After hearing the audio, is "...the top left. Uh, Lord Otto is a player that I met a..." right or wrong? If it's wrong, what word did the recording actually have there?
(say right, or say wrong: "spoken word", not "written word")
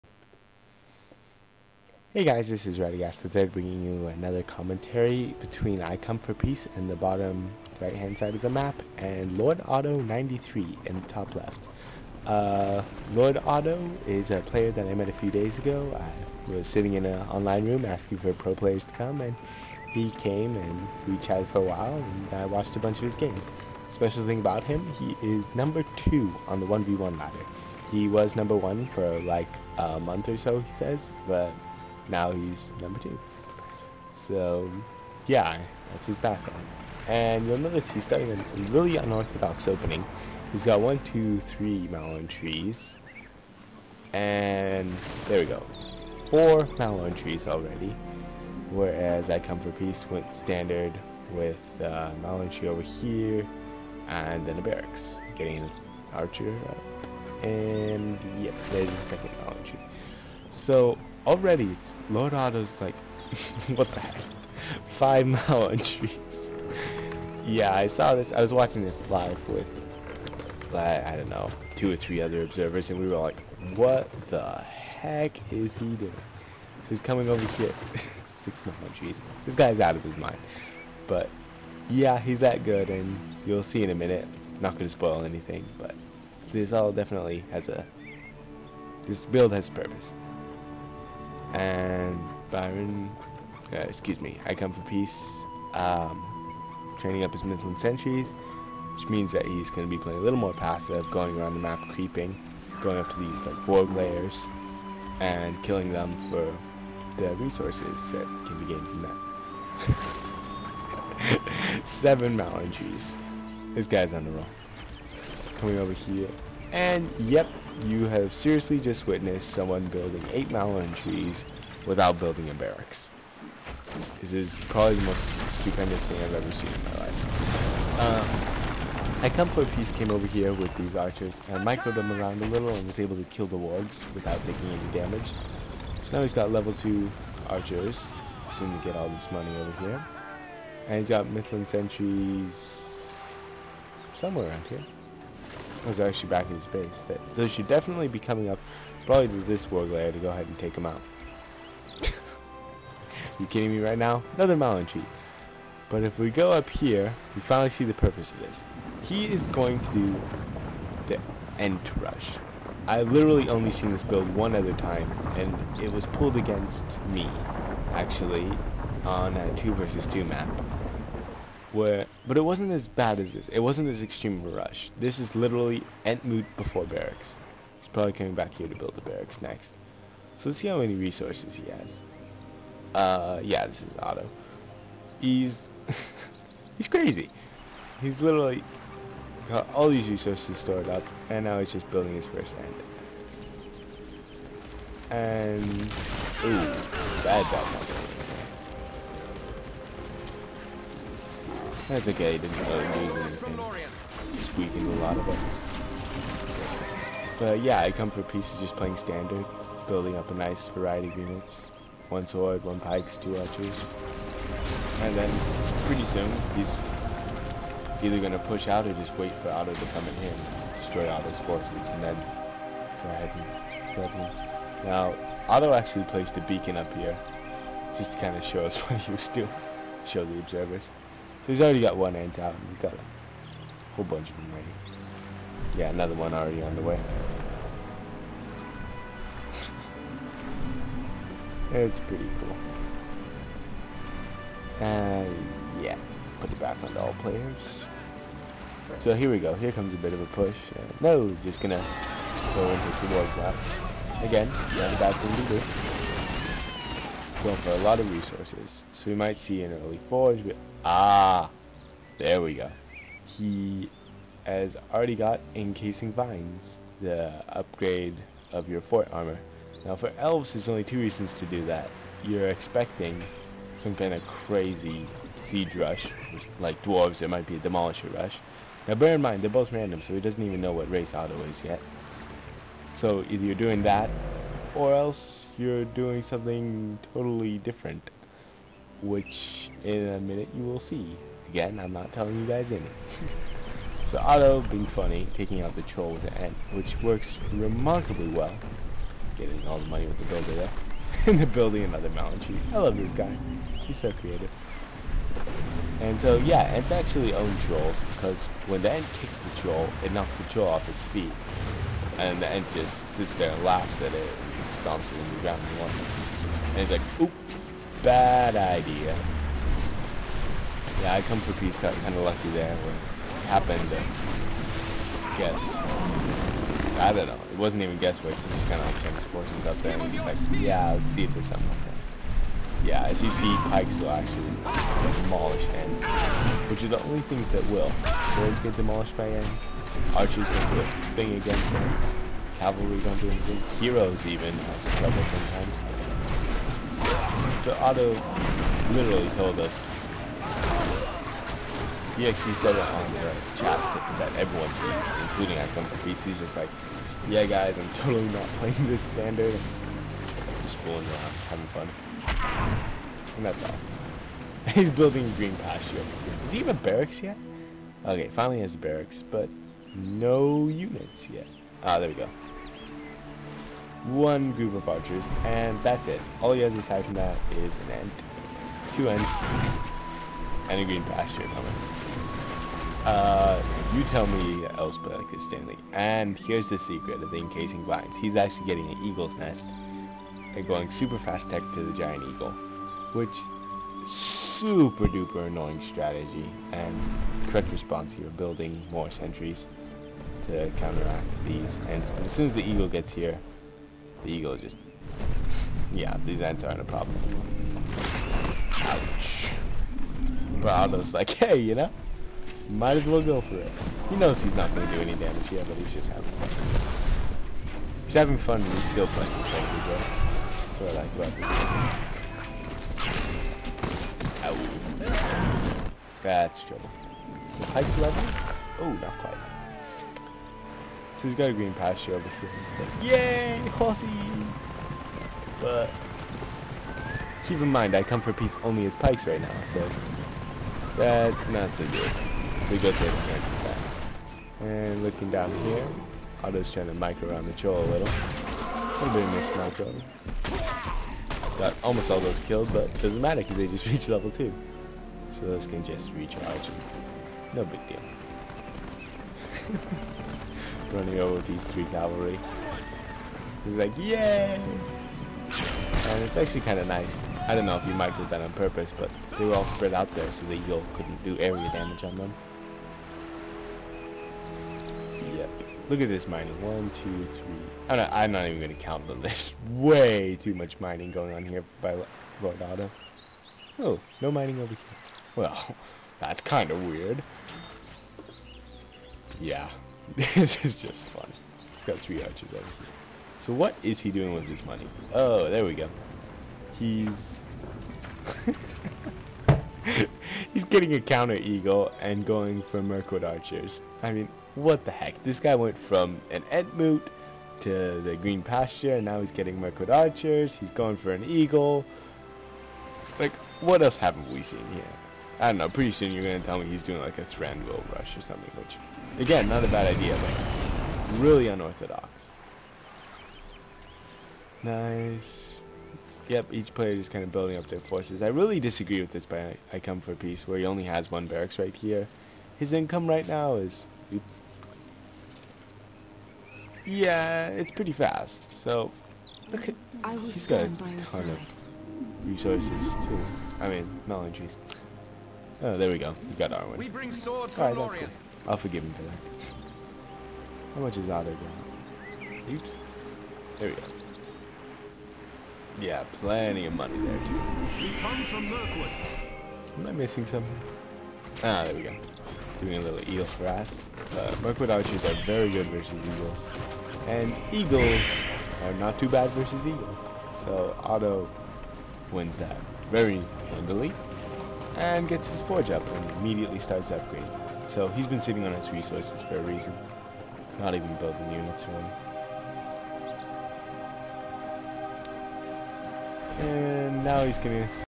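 right.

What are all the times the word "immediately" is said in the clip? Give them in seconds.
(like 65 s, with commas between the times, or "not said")
576 s.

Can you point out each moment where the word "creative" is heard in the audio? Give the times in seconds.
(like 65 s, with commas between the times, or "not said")
304 s.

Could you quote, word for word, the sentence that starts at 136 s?
So now he's got level 2 archers, soon to get all this money over here.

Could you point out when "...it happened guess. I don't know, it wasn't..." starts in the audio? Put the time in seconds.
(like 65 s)
322 s.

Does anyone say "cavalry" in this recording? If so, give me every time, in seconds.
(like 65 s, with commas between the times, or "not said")
342 s, 461 s.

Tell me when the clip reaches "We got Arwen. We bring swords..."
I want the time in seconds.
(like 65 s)
546 s.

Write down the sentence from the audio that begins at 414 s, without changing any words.
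He knows he's not going to do any damage, yet, but he's just having fun.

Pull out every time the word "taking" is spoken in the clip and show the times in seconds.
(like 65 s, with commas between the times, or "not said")
134 s, 295 s.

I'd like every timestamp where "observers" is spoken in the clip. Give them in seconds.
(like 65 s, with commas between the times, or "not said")
72 s, 230 s.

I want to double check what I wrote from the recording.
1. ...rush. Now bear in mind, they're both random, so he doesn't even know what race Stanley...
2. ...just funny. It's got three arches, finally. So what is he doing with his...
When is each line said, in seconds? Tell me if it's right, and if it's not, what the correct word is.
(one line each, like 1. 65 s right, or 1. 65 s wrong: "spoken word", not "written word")
1. 278 s wrong: "Otto", not "Stanley"
2. 490 s wrong: "obviously", not "finally".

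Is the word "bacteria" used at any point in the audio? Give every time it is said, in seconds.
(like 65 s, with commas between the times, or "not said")
not said.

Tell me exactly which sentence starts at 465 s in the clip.
And it's actually kind of nice.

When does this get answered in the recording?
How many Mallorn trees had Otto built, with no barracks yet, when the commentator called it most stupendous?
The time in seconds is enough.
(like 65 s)
120 s.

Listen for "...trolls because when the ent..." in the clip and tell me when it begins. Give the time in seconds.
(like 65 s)
307 s.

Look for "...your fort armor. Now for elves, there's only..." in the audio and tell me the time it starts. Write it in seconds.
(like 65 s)
268 s.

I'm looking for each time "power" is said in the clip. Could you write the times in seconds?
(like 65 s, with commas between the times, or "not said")
not said.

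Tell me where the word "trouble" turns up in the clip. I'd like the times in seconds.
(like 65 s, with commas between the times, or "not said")
344 s, 426 s.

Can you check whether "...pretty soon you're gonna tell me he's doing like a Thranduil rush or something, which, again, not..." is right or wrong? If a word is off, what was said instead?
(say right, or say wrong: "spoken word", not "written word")
right.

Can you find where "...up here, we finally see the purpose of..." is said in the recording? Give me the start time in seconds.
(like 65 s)
156 s.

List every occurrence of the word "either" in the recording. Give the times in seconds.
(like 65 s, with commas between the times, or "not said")
218 s, 283 s.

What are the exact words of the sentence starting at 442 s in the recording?
So we go take and cancels that.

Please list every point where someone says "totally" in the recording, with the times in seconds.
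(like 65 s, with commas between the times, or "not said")
287 s, 357 s.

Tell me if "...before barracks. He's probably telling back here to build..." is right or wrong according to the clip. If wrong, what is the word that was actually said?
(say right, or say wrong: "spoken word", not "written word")
wrong: "coming", not "telling".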